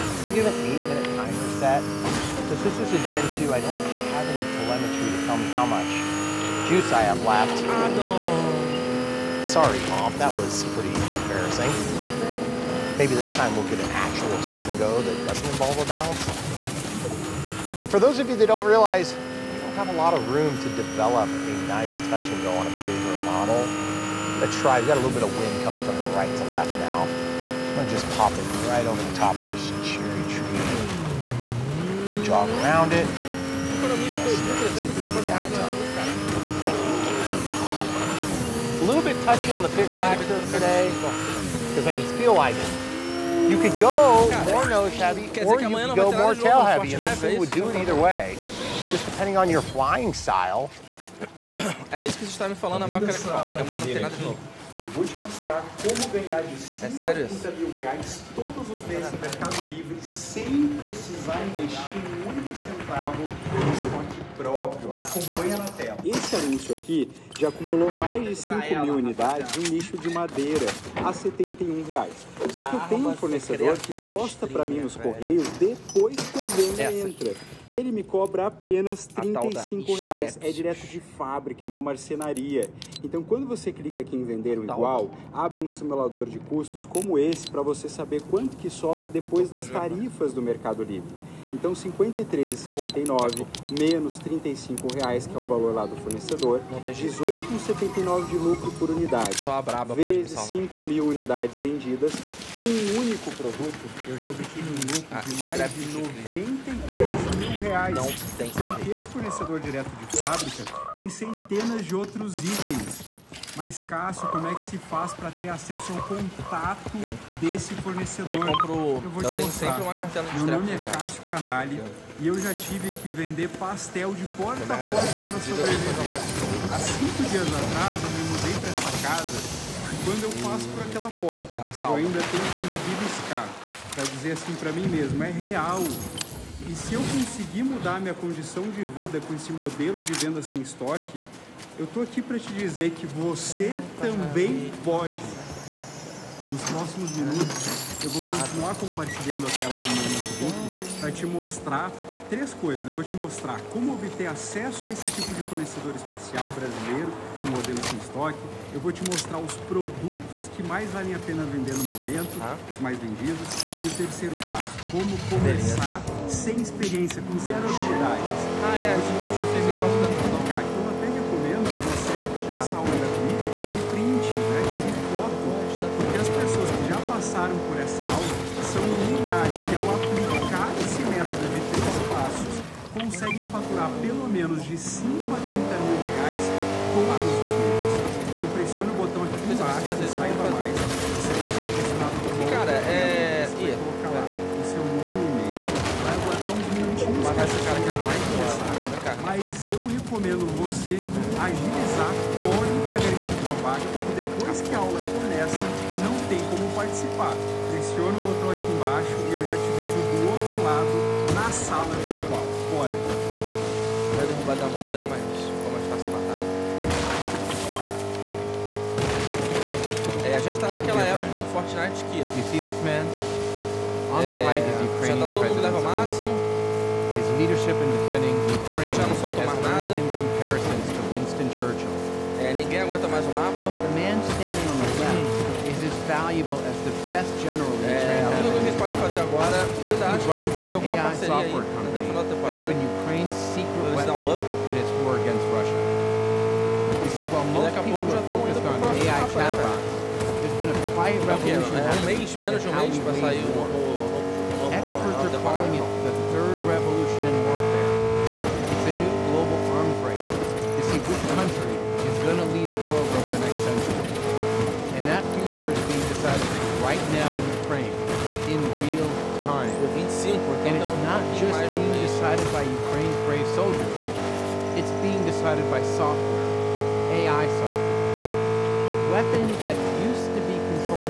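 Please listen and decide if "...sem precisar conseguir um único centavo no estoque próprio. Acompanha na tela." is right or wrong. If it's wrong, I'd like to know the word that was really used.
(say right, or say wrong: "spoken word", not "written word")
wrong: "investir", not "conseguir".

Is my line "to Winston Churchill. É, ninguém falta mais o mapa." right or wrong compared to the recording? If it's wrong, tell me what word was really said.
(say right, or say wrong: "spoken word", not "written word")
wrong: "aguenta", not "falta".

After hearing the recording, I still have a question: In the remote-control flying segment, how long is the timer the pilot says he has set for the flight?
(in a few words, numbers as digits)
8 minutes.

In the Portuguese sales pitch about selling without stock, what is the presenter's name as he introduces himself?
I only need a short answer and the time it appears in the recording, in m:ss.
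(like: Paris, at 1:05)
Cássio Canali, at 2:00.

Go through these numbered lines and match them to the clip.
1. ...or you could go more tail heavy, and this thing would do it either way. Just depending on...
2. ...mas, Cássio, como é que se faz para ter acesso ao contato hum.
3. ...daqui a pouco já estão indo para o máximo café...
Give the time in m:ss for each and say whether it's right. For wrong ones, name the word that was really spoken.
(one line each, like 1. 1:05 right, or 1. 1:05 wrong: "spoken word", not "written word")
1. 0:45 right
2. 1:53 right
3. 4:07 wrong: "próximo", not "máximo".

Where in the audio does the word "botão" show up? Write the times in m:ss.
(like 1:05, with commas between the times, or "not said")
3:08, 3:28.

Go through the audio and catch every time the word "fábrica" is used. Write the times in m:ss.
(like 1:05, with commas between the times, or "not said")
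1:20, 1:50.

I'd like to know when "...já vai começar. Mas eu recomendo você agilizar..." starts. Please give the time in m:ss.
3:17.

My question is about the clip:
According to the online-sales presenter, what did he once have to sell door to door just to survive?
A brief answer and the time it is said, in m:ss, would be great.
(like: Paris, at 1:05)
pastel, at 2:03.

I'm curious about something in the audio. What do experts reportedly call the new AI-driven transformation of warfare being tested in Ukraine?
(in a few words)
third revolution in warfare.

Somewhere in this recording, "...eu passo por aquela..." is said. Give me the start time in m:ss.
2:10.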